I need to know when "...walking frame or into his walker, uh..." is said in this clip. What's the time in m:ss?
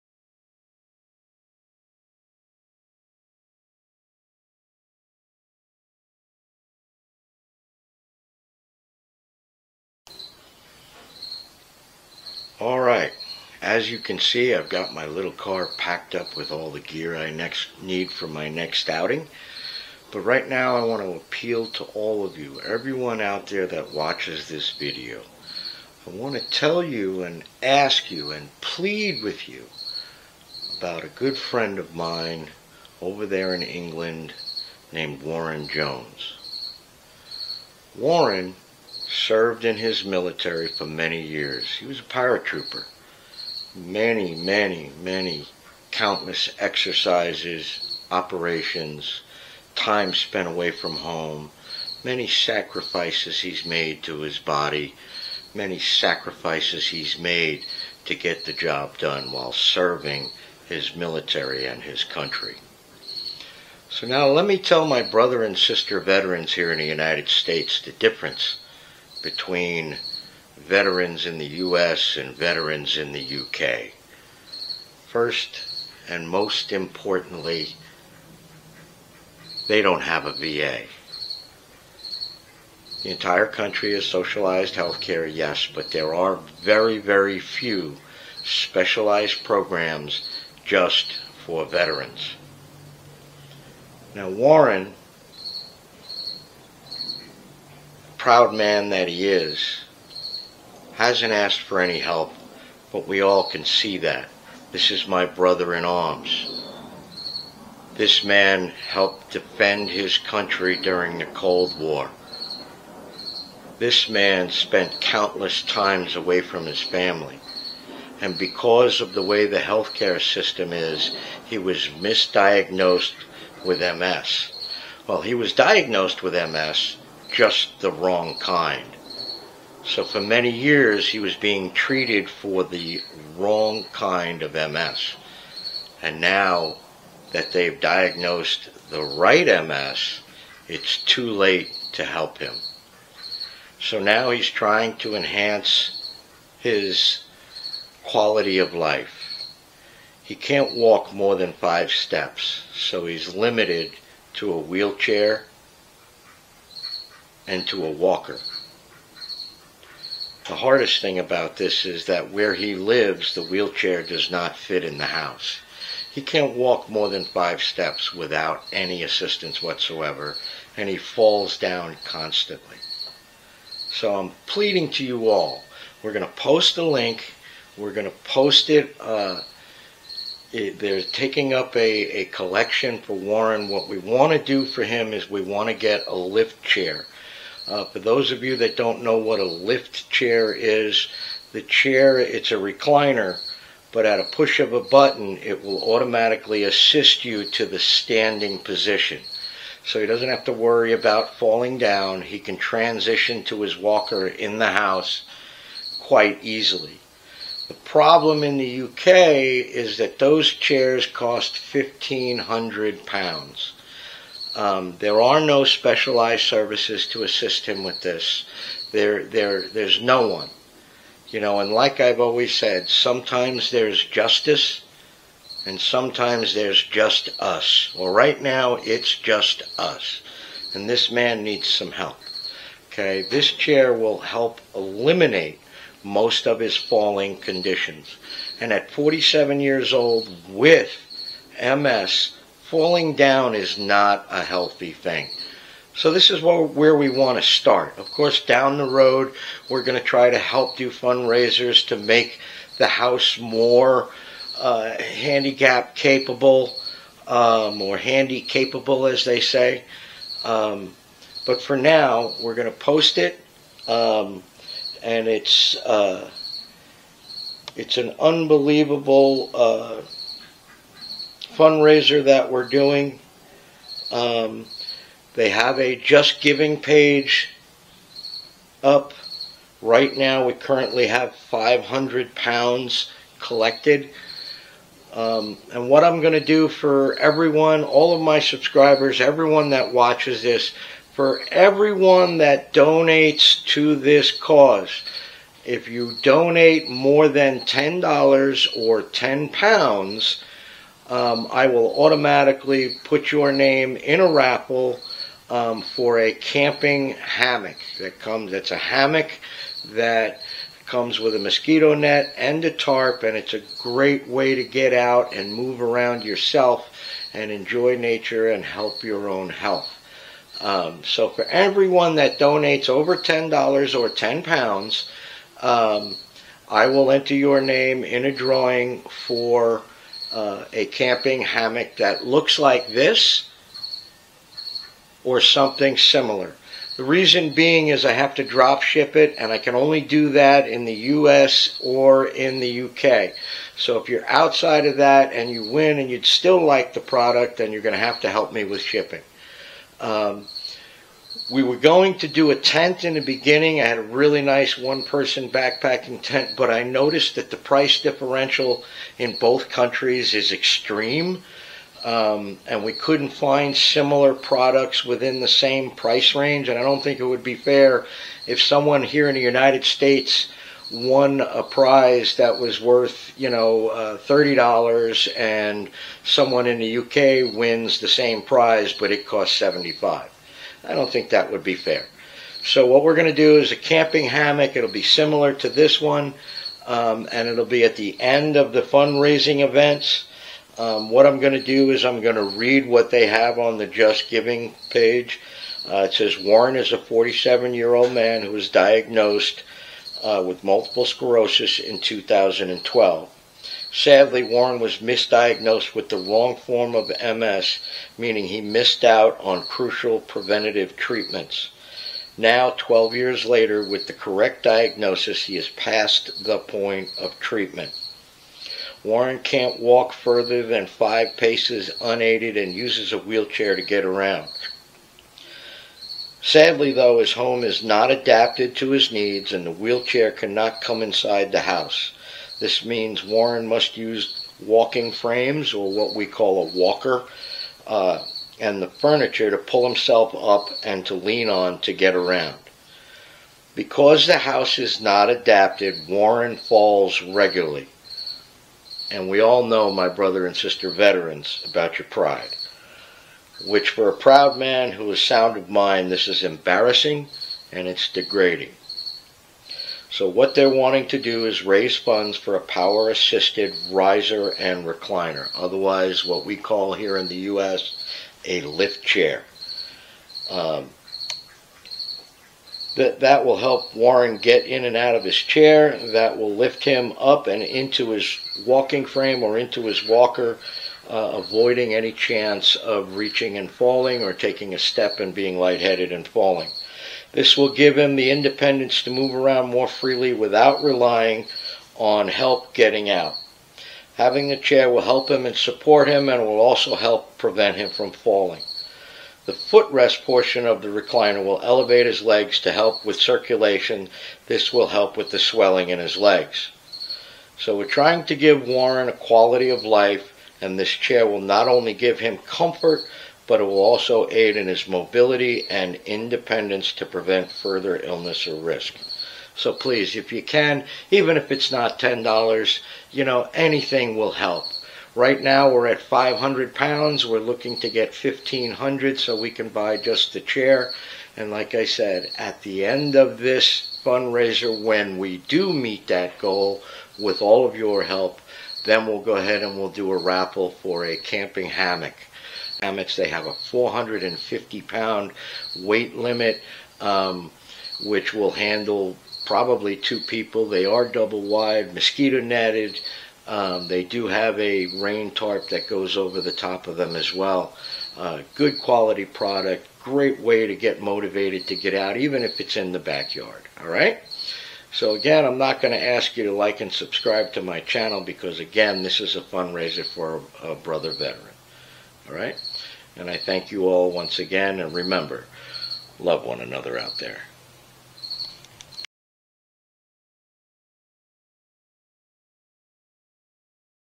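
7:58.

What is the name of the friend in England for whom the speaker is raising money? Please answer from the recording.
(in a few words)
Warren Jones.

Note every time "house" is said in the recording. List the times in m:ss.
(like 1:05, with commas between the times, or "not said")
2:45, 3:24, 4:12, 7:11, 7:24.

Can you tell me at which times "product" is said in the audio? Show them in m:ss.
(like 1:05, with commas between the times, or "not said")
5:46, 6:04, 9:19.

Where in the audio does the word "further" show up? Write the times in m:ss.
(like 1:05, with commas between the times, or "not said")
7:00, 8:37.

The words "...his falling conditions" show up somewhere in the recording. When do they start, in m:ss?
3:56.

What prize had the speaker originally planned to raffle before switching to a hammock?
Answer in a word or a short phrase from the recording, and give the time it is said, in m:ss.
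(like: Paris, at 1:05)
One person backpacking tent, at 5:54.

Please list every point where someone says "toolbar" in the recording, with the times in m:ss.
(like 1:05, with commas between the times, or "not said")
not said.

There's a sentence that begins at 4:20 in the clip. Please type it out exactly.
Um, but for now, we're going to post it, um, and it's uh, it's an unbelievable uh, fundraiser that we're doing.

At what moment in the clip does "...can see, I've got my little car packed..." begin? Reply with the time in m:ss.
0:13.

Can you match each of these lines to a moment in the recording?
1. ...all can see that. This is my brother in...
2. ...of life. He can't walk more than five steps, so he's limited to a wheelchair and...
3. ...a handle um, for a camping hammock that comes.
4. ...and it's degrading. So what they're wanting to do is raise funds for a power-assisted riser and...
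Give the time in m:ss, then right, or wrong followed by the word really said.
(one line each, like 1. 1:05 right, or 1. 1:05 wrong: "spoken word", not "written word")
1. 1:43 right
2. 2:28 right
3. 5:04 wrong: "raffle", not "handle"
4. 7:37 right.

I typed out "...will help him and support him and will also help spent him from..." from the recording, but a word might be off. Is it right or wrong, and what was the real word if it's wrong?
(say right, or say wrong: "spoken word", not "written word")
wrong: "prevent", not "spent".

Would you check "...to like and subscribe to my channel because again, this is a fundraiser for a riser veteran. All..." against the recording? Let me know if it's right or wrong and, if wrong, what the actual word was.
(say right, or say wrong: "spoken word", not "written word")
wrong: "brother", not "riser".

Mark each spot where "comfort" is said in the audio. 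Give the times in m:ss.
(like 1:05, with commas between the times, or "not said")
8:32.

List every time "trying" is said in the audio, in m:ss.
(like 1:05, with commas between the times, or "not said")
2:24, 8:27.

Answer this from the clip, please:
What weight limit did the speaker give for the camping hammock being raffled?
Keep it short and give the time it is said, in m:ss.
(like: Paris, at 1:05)
450 pounds, at 9:03.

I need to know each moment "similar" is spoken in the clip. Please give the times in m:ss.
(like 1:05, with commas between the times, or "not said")
5:35, 6:03, 6:25.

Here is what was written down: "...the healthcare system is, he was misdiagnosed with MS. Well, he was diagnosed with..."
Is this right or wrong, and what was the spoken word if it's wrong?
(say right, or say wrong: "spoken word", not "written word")
right.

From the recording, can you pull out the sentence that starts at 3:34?
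Um, there are no specialized services to assist him with this.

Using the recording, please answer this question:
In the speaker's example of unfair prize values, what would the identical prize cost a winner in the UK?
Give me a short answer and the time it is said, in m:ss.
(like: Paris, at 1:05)
75, at 6:19.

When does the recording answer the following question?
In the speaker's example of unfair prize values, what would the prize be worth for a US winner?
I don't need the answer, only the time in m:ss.
6:14.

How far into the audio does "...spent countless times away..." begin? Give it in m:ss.
1:54.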